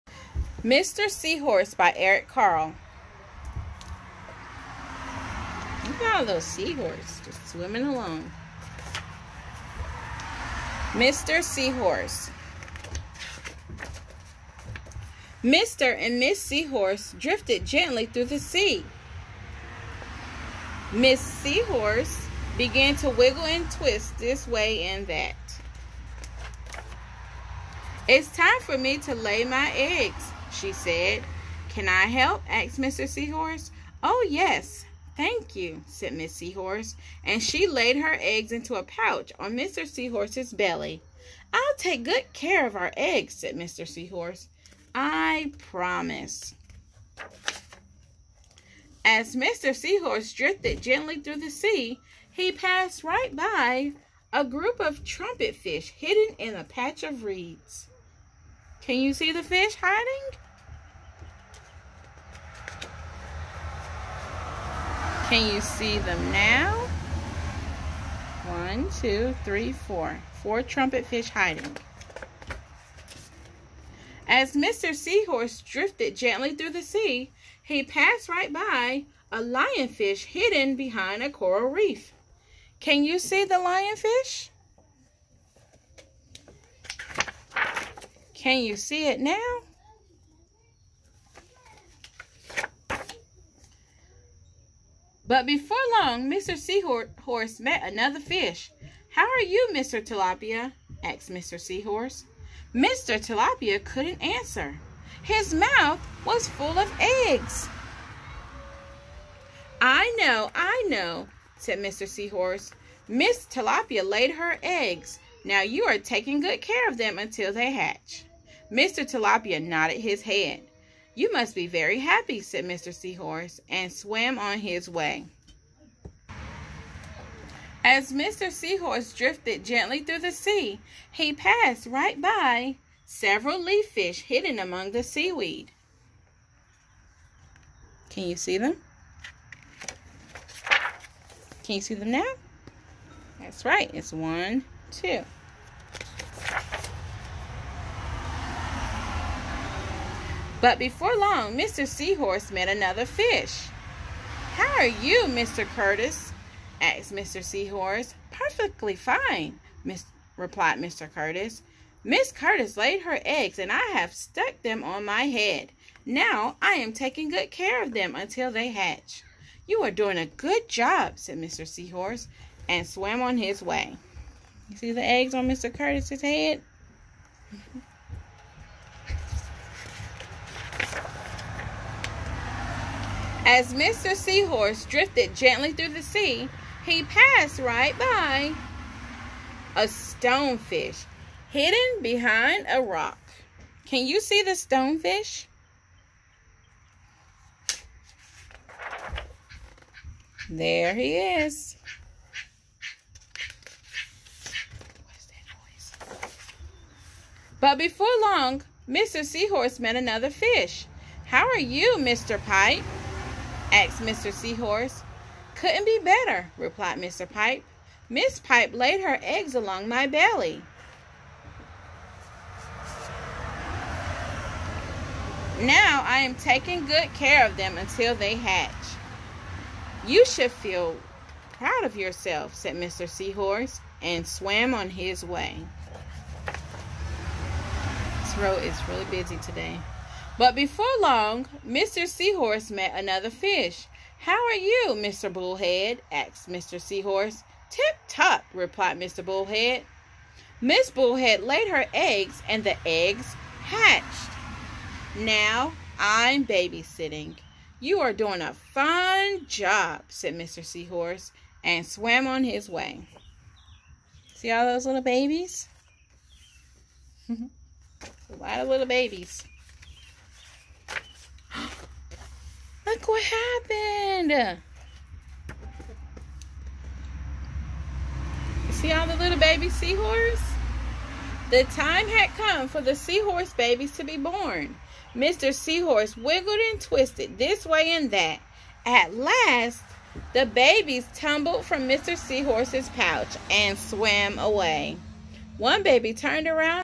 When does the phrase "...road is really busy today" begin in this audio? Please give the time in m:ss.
3:58.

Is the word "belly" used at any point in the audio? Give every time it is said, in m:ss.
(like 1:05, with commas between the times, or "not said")
0:40, 3:40.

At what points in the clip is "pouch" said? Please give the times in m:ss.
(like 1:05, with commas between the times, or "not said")
0:38, 4:52.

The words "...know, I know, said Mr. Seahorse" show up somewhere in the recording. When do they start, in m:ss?
1:50.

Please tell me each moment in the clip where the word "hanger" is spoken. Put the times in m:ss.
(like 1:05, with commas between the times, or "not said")
not said.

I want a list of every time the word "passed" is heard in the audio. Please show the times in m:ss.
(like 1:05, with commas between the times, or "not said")
0:52, 1:17, 2:11, 3:07.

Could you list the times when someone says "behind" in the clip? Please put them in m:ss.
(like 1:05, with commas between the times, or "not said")
1:20, 3:12.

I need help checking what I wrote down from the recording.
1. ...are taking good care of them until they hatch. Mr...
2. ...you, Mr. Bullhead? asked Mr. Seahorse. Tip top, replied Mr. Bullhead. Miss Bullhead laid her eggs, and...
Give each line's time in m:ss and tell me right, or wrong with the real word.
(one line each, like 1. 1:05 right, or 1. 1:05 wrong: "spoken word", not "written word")
1. 1:55 right
2. 4:04 right.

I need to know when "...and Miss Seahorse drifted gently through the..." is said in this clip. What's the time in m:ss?
0:15.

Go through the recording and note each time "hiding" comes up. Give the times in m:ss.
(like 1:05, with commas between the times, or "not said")
0:59, 1:11.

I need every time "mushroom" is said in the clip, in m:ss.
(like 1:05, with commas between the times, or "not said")
not said.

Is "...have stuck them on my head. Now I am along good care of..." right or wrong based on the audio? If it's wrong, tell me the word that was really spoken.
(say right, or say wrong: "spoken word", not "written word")
wrong: "taking", not "along".